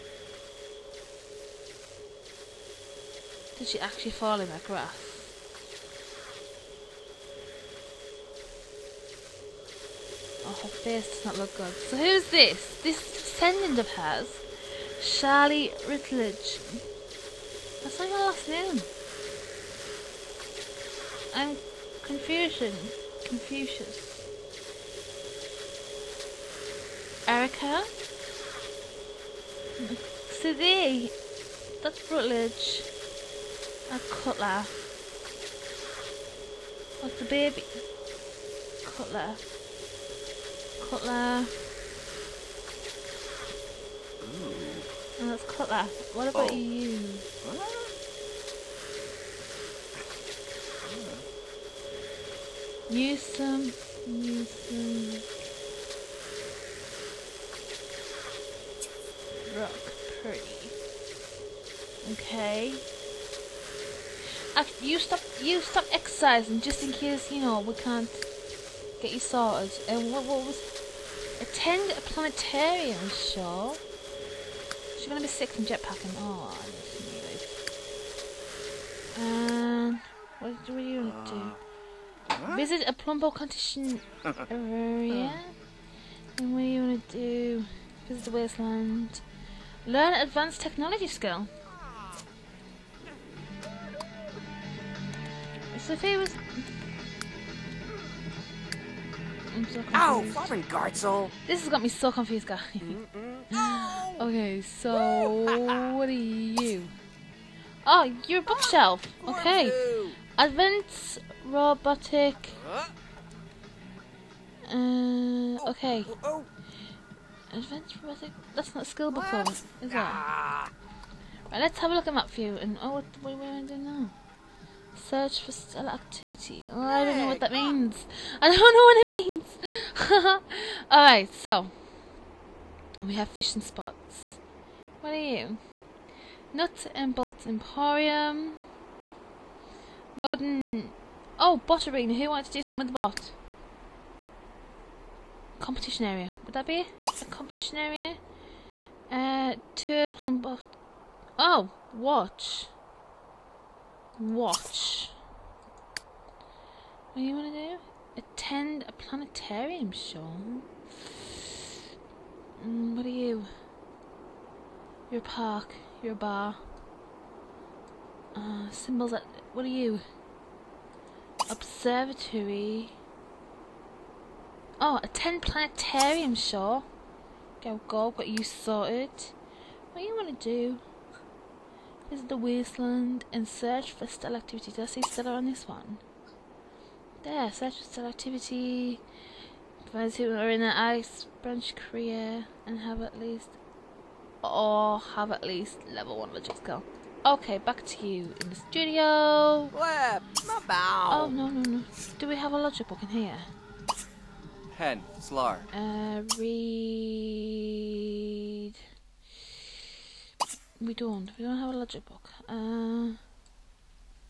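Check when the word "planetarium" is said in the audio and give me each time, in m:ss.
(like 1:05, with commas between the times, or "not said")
1:12, 2:38, 2:55.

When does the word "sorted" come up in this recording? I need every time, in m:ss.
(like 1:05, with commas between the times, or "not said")
1:09, 2:58.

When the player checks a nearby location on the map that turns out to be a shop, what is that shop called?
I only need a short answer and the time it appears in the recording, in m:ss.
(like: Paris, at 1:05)
Nut and Bolt Emporium, at 2:16.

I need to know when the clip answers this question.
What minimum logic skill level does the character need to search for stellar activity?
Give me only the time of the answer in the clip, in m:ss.
3:15.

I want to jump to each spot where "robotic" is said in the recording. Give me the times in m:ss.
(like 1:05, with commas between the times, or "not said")
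1:51, 1:58.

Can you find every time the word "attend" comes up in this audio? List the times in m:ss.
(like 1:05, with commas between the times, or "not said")
1:11, 2:38, 2:55.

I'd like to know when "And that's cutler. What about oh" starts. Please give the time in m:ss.
0:45.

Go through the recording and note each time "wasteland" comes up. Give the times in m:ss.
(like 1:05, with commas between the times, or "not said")
1:28, 3:02.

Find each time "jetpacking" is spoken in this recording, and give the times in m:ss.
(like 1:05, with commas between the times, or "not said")
1:15.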